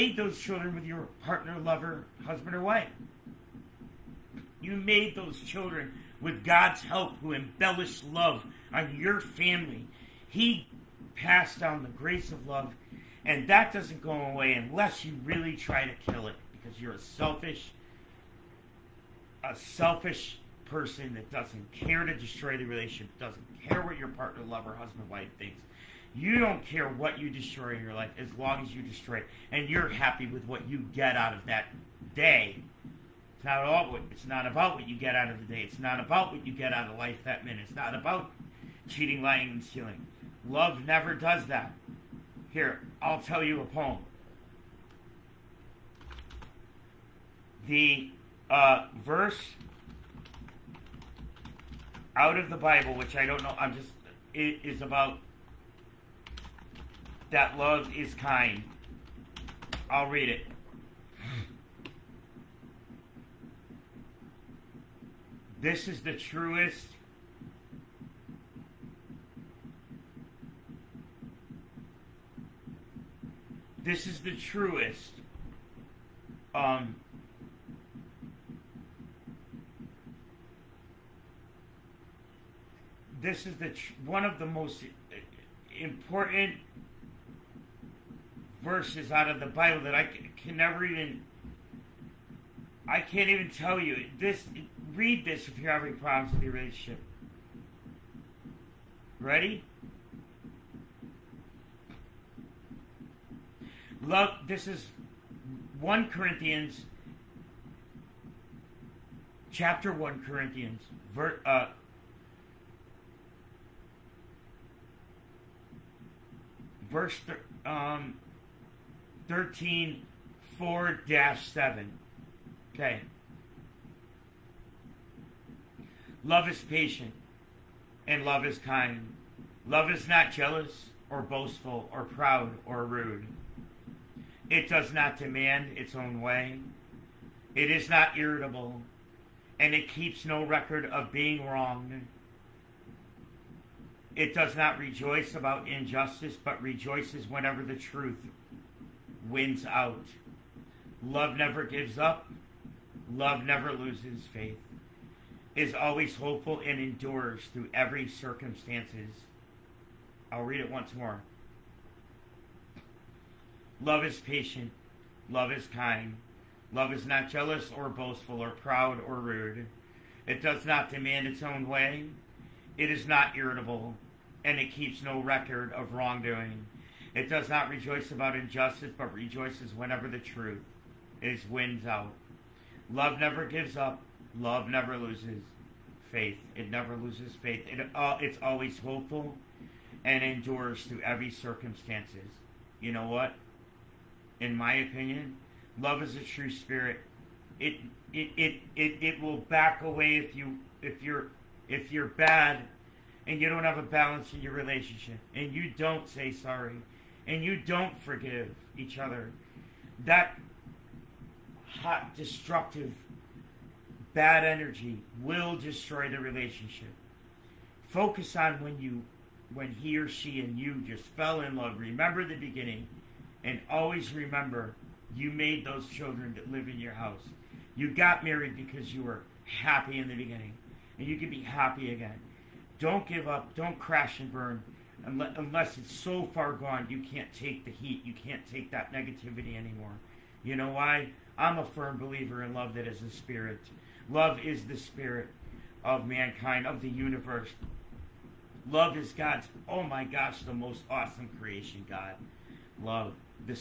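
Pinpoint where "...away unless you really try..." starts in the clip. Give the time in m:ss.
0:14.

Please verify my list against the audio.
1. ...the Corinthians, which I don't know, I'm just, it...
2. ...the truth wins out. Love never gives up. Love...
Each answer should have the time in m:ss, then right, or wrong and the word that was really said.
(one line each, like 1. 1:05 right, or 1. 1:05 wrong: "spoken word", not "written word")
1. 0:52 wrong: "Bible", not "Corinthians"
2. 2:27 right.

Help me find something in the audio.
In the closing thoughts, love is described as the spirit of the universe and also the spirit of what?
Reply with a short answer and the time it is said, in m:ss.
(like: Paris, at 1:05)
mankind, at 4:06.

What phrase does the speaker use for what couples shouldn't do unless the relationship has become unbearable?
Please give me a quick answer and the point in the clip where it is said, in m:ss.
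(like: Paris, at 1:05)
crash and burn, at 3:53.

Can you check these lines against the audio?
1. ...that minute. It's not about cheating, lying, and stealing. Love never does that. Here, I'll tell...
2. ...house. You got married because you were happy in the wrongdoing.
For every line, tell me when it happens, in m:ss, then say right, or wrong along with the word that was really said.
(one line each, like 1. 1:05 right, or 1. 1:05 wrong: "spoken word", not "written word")
1. 0:37 right
2. 3:46 wrong: "beginning", not "wrongdoing".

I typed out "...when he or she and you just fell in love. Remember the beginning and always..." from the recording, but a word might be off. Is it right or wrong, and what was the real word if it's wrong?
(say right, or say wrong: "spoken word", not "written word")
right.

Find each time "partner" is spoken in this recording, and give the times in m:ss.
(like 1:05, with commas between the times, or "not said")
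0:01, 0:24.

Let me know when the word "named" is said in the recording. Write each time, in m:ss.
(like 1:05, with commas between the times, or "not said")
not said.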